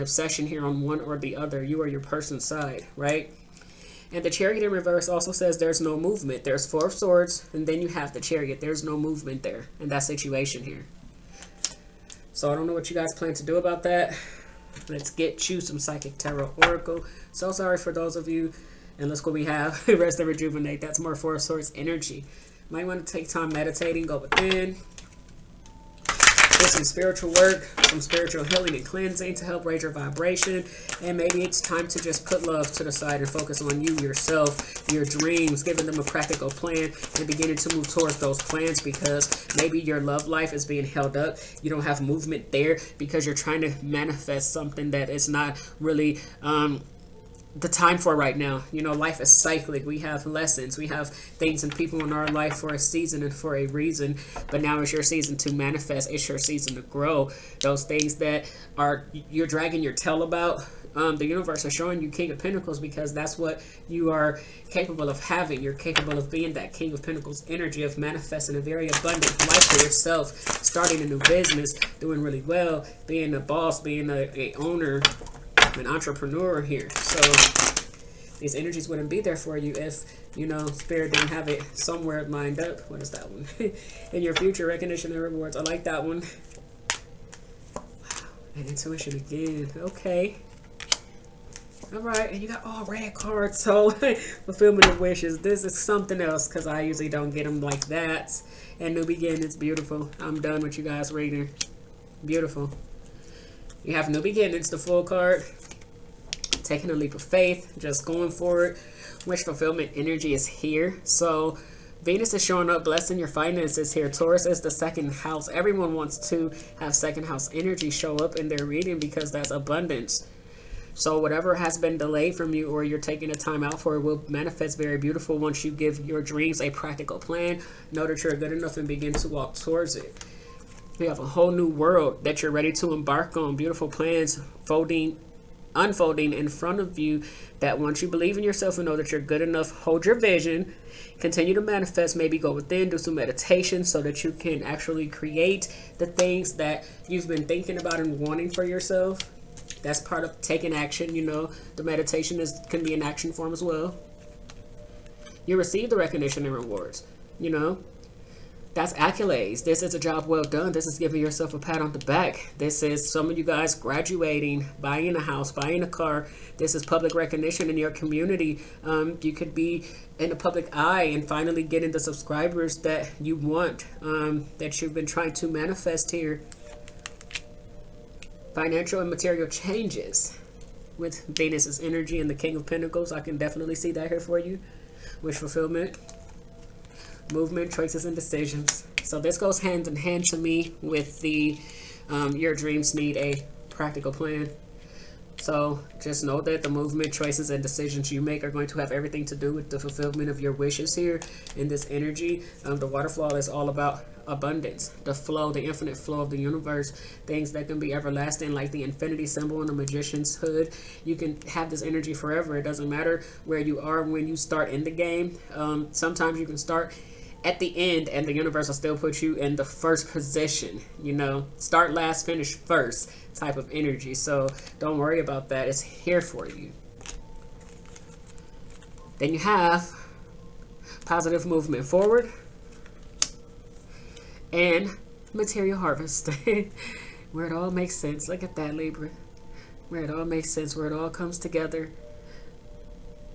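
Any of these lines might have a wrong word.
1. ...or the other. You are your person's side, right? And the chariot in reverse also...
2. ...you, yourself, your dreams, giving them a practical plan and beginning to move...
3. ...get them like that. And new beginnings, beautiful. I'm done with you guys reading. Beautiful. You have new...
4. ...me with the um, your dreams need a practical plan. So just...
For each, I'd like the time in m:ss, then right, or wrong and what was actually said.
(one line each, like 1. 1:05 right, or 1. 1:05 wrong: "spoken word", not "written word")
1. 0:01 right
2. 0:33 right
3. 1:37 right
4. 3:10 right.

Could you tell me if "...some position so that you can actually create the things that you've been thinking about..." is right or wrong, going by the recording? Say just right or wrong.
wrong.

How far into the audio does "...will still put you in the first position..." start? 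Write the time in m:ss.
3:38.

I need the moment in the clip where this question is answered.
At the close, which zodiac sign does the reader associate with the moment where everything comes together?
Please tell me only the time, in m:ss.
3:58.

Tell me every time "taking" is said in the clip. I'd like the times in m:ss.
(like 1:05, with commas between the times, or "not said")
1:46, 2:02, 2:30.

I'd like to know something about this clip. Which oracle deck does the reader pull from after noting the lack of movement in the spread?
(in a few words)
Psychic Tarot Oracle.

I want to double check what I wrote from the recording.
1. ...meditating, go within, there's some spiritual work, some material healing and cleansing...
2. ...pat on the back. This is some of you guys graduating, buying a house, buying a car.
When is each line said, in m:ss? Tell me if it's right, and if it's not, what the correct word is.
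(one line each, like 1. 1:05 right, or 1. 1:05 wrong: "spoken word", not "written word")
1. 0:23 wrong: "spiritual", not "material"
2. 2:41 right.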